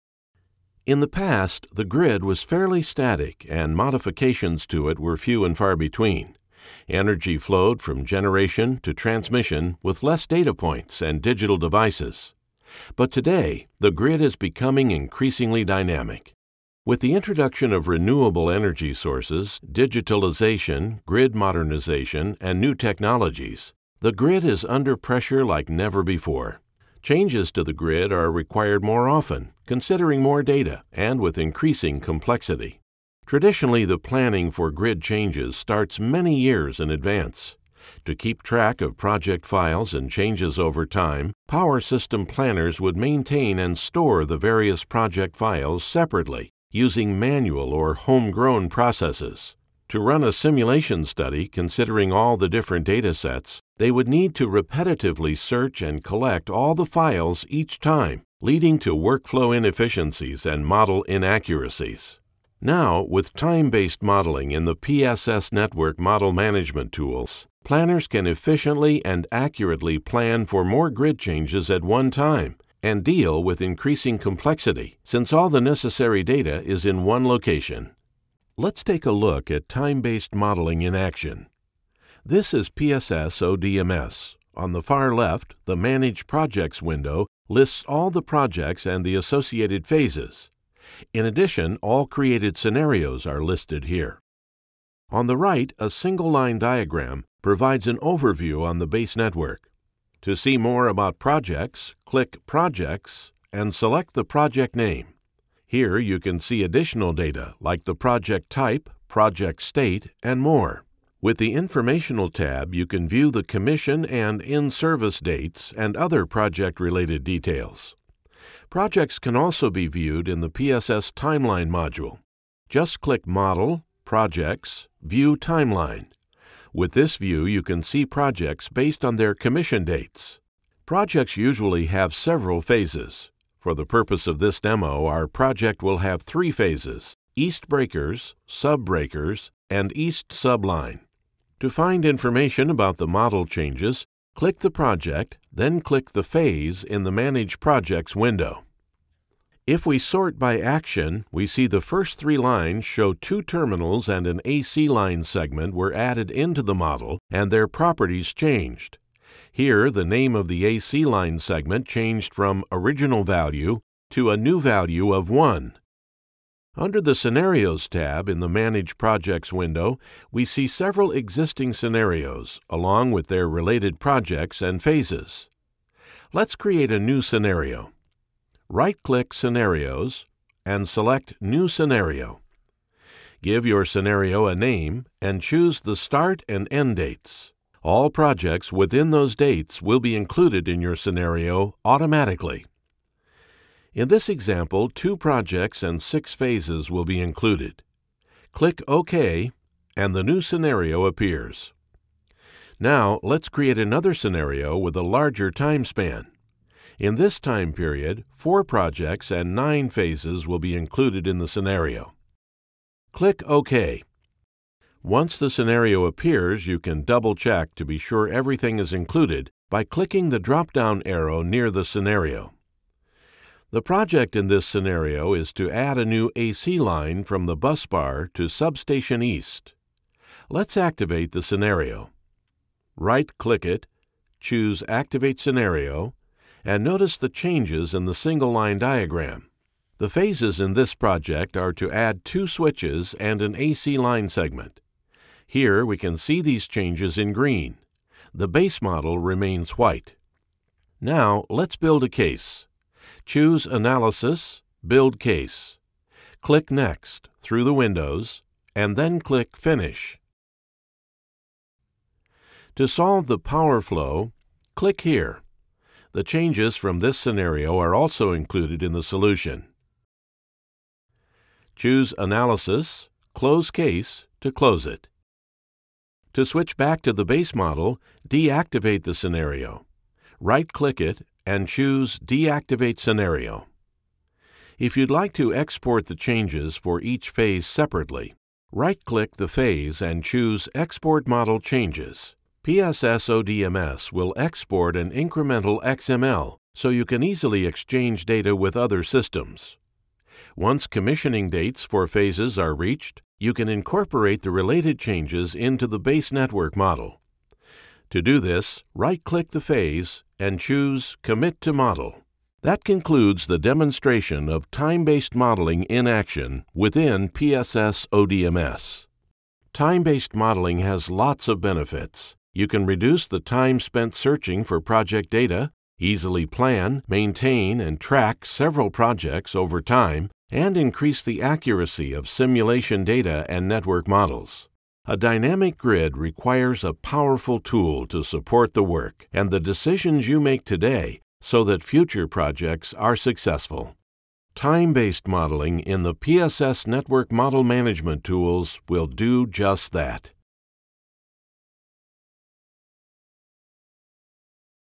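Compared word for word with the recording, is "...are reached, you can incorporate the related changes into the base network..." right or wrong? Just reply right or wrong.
right.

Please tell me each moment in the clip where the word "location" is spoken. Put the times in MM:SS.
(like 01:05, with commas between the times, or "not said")
01:17.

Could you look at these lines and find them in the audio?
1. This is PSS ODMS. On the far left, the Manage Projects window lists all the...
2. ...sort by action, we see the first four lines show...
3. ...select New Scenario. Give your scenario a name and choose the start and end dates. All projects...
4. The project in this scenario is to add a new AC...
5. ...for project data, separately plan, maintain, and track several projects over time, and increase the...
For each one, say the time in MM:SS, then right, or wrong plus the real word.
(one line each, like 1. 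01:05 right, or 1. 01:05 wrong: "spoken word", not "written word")
1. 01:22 right
2. 02:29 wrong: "three", not "four"
3. 03:00 right
4. 03:43 right
5. 05:24 wrong: "easily", not "separately".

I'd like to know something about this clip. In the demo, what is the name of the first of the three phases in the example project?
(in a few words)
East Breakers.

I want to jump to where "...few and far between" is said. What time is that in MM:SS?
00:05.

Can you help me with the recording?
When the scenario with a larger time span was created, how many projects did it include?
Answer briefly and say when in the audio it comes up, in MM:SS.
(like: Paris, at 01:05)
4, at 03:28.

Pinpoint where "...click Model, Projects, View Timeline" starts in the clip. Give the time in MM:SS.
02:03.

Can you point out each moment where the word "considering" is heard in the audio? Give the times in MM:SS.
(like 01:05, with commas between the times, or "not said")
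00:29, 00:51.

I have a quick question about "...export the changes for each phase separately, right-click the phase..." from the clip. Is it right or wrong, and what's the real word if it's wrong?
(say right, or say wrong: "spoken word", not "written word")
right.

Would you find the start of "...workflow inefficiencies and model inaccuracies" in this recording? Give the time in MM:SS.
00:58.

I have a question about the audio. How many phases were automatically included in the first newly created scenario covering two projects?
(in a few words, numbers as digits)
6.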